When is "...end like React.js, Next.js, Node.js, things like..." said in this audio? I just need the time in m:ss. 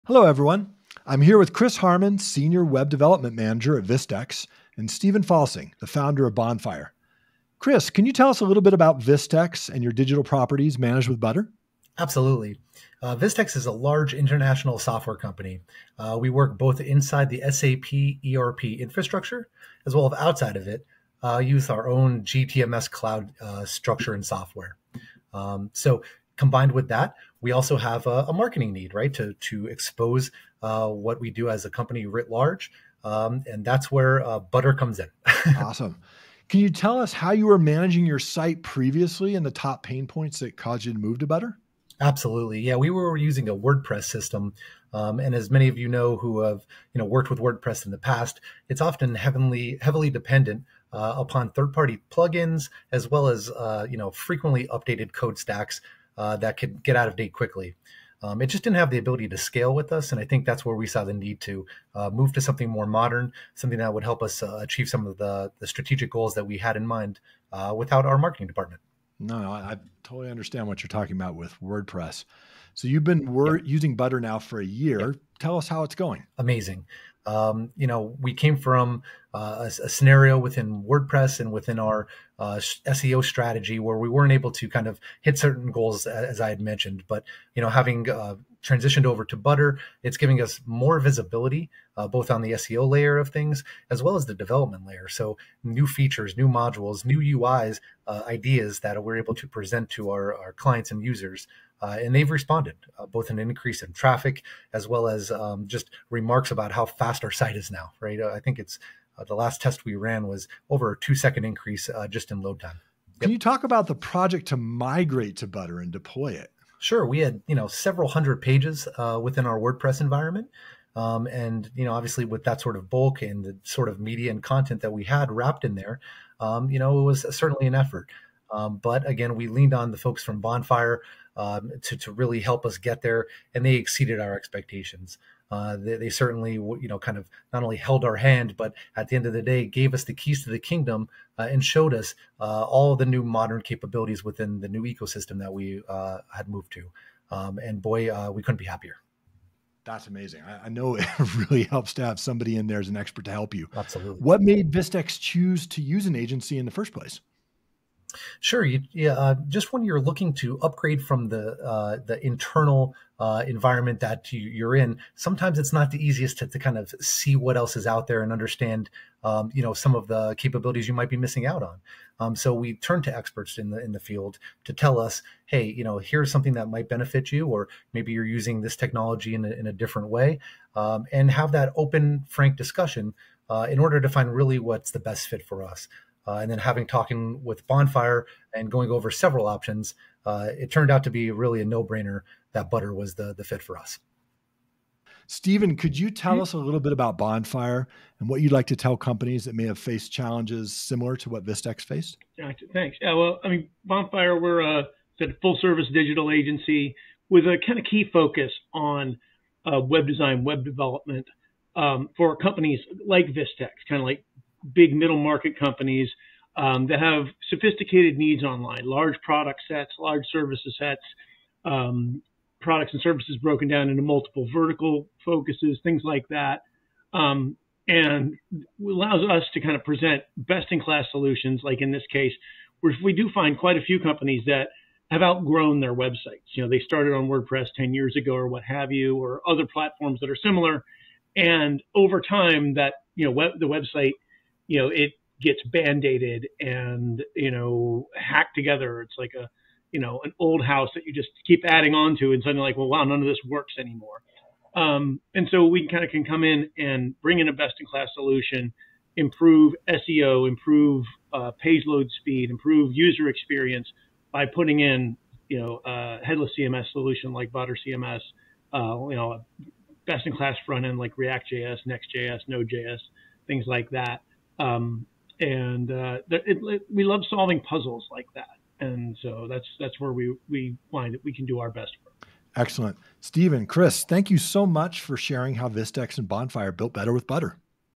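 4:30.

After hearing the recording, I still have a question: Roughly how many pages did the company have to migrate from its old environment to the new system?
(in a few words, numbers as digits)
several hundred.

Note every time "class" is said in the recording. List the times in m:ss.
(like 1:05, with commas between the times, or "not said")
3:50, 4:17, 4:30.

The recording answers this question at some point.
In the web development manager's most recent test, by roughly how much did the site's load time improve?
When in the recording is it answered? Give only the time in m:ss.
1:50.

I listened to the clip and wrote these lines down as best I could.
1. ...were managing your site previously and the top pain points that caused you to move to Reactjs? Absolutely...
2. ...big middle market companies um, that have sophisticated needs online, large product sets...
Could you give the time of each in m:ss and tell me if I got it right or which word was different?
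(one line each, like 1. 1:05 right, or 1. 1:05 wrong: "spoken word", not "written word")
1. 0:37 wrong: "Butter", not "Reactjs"
2. 3:34 right.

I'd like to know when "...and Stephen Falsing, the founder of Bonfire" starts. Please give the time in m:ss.
0:04.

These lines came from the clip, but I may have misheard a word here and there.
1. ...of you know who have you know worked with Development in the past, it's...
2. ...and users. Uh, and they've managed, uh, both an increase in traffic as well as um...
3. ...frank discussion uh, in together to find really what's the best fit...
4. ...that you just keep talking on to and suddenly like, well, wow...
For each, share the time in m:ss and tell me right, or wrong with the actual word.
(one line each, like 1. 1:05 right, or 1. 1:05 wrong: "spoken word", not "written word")
1. 0:45 wrong: "WordPress", not "Development"
2. 1:40 wrong: "responded", not "managed"
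3. 3:02 wrong: "order", not "together"
4. 4:10 wrong: "adding", not "talking".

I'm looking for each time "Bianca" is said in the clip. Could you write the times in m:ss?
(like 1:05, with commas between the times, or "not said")
not said.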